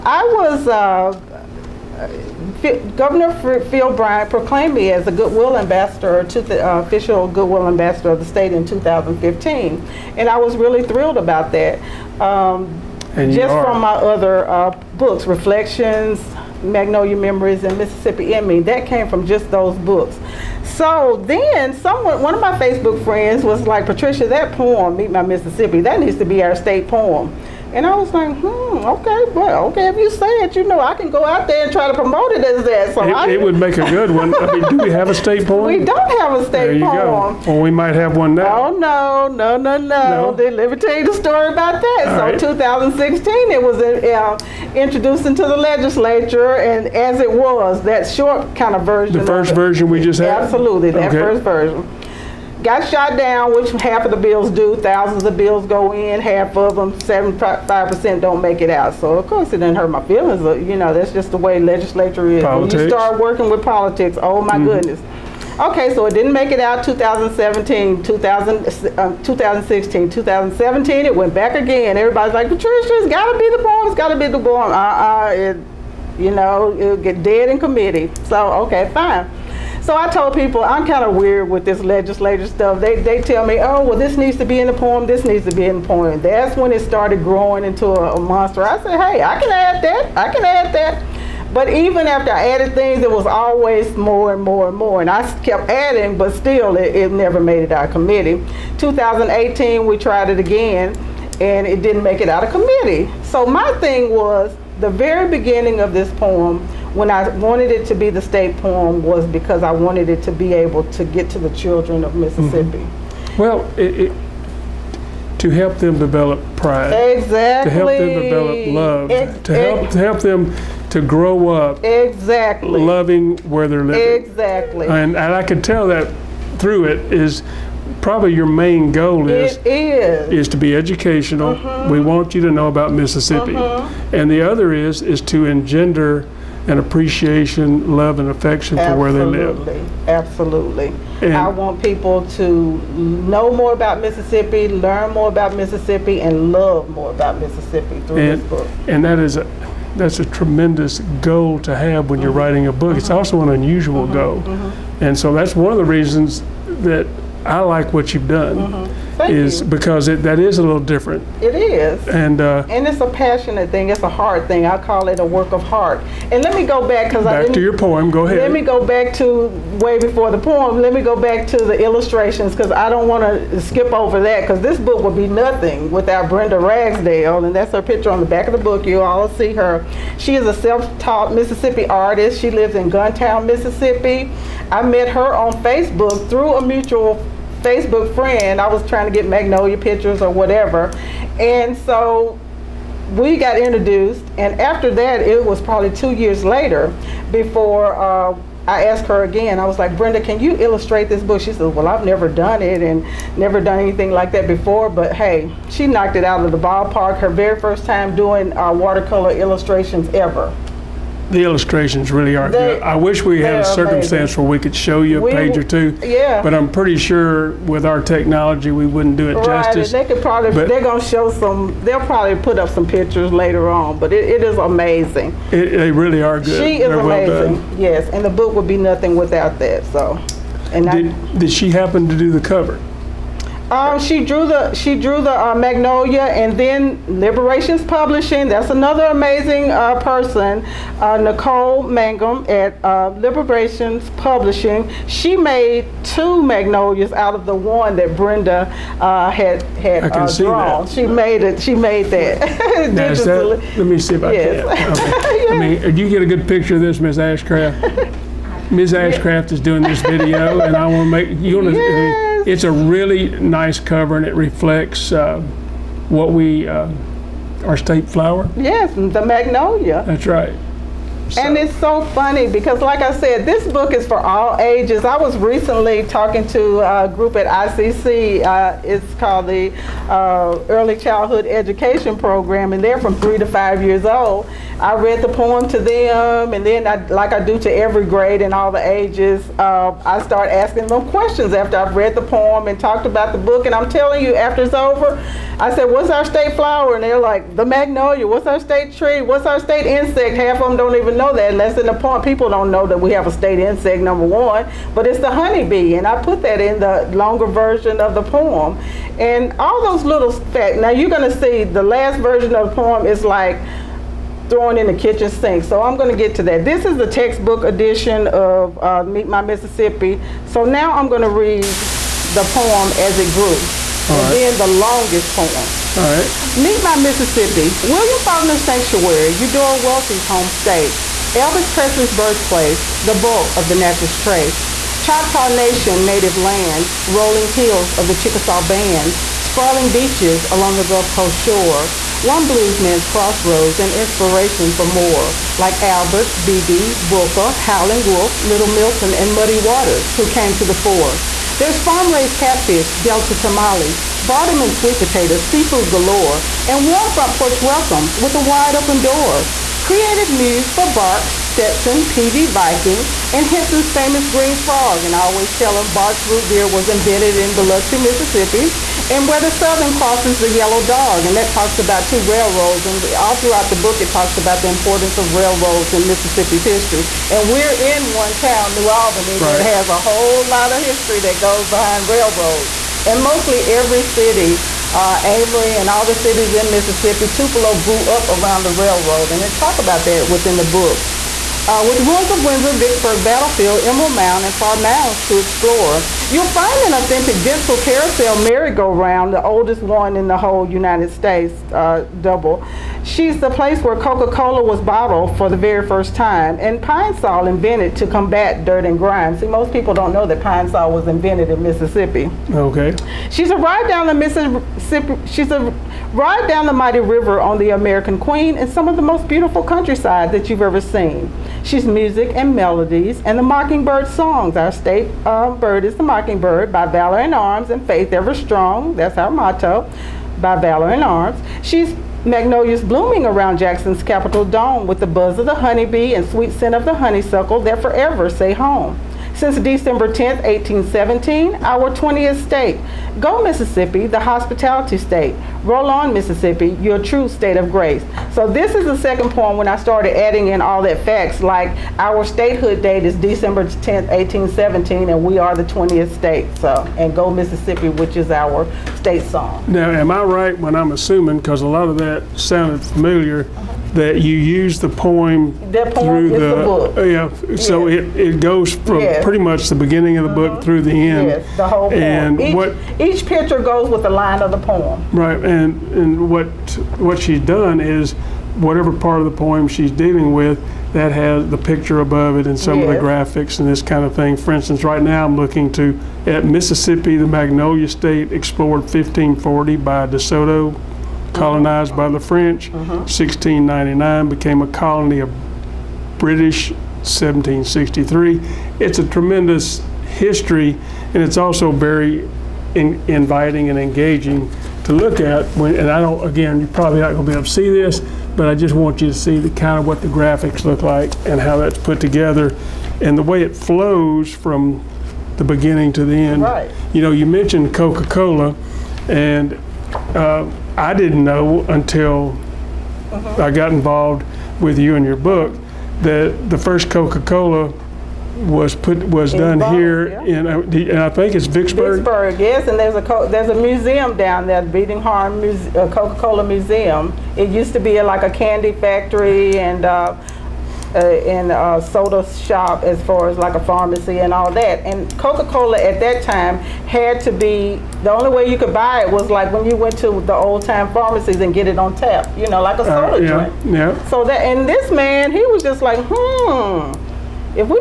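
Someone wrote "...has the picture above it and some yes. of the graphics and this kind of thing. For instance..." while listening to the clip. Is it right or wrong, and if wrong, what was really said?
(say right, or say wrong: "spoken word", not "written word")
right.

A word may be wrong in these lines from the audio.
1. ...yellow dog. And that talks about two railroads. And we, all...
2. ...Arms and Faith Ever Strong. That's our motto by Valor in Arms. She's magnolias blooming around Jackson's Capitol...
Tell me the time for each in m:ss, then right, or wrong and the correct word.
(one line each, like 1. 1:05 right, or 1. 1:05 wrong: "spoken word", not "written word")
1. 6:10 right
2. 7:07 right.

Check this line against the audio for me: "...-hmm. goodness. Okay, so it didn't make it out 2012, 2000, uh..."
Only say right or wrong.
wrong.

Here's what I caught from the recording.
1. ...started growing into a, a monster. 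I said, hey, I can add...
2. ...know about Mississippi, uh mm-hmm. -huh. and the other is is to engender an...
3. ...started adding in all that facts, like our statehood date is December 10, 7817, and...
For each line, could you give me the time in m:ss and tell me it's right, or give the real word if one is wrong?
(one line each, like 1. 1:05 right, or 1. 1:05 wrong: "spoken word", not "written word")
1. 1:26 right
2. 2:12 right
3. 7:29 wrong: "1817", not "7817".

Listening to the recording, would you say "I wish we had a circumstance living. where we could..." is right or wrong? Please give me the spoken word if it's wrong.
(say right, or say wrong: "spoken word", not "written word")
wrong: "amazing", not "living".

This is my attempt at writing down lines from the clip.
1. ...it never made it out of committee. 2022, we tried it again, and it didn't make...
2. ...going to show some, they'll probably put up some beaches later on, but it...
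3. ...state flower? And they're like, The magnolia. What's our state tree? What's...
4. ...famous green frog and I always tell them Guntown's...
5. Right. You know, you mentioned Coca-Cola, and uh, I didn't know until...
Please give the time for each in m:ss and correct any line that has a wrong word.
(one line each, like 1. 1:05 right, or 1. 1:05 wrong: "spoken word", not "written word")
1. 1:36 wrong: "2018", not "2022"
2. 3:40 wrong: "pictures", not "beaches"
3. 4:56 right
4. 6:03 wrong: "Barq", not "Guntown"
5. 8:36 right.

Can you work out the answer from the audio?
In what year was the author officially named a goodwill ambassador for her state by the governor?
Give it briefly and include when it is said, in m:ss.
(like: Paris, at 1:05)
2015, at 0:08.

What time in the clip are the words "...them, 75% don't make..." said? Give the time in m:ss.
0:56.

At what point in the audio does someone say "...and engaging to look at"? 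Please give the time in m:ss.
8:23.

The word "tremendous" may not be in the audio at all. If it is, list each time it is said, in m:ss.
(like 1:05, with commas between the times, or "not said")
2:30, 8:19.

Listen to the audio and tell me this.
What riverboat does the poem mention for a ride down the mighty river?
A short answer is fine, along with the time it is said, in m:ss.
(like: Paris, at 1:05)
American Queen, at 6:57.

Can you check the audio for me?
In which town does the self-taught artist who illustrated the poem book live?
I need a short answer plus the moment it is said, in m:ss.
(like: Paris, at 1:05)
Guntown, Mississippi, at 3:02.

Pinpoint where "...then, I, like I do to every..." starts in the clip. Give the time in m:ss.
4:46.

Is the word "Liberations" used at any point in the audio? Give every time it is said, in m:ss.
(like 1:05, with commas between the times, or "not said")
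3:57, 4:03.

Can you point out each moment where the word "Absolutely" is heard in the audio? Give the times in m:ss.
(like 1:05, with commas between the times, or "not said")
0:50, 2:20.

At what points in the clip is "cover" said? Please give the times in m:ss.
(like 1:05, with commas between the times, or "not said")
3:52, 4:23.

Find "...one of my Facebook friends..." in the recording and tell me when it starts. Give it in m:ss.
0:22.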